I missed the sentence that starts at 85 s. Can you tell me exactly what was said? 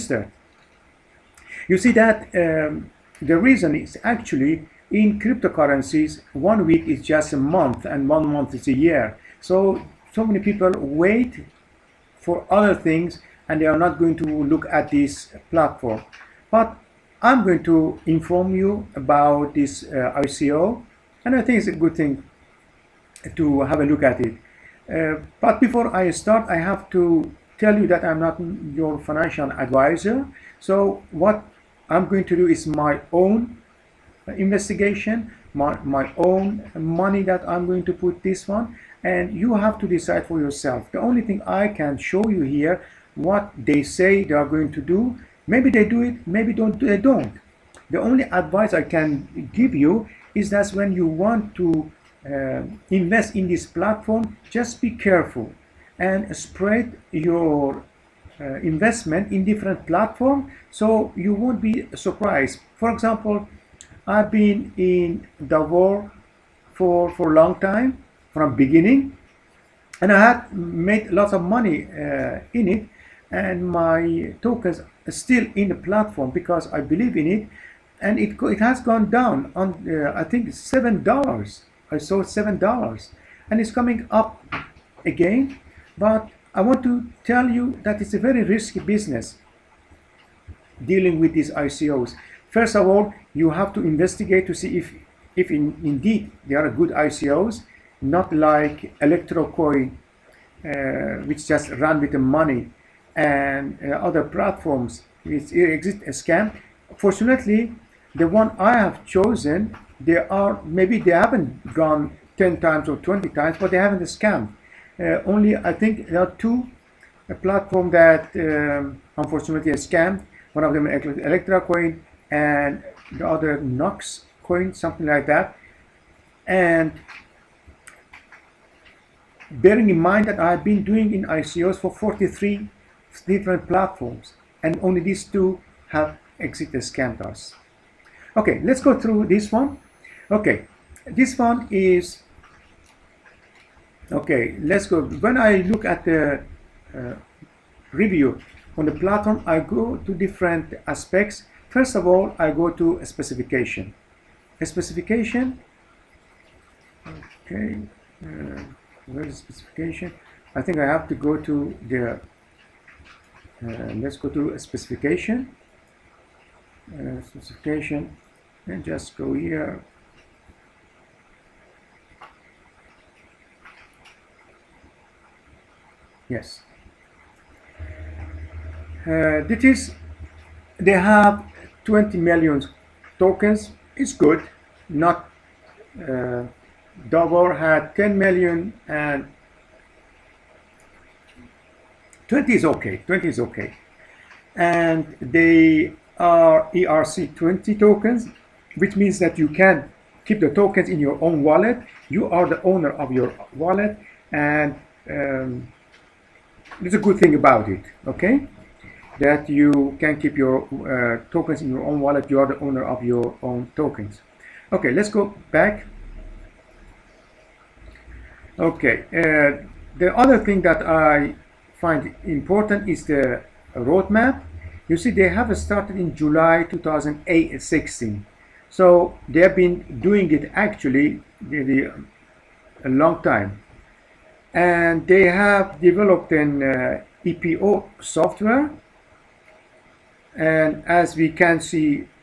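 But I want to tell you that it's a very risky business dealing with these ICOs.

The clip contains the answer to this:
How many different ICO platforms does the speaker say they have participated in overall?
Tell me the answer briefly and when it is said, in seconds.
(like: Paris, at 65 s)
43, at 131 s.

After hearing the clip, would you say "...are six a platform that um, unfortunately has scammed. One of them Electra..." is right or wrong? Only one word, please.
wrong.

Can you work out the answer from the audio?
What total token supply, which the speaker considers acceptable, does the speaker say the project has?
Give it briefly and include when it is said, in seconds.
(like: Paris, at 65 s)
20 million, at 181 s.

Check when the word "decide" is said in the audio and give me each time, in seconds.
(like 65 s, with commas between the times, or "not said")
39 s.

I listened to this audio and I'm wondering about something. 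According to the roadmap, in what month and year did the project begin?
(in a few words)
July 2016.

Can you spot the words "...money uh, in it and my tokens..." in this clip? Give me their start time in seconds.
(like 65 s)
71 s.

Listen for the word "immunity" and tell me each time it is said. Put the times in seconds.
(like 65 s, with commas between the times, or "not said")
not said.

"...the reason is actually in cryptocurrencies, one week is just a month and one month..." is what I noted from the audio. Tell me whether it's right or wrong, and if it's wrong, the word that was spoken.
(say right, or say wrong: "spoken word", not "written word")
right.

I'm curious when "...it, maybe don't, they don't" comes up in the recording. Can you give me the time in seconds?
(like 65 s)
46 s.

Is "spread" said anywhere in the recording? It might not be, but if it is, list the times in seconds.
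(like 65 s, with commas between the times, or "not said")
56 s.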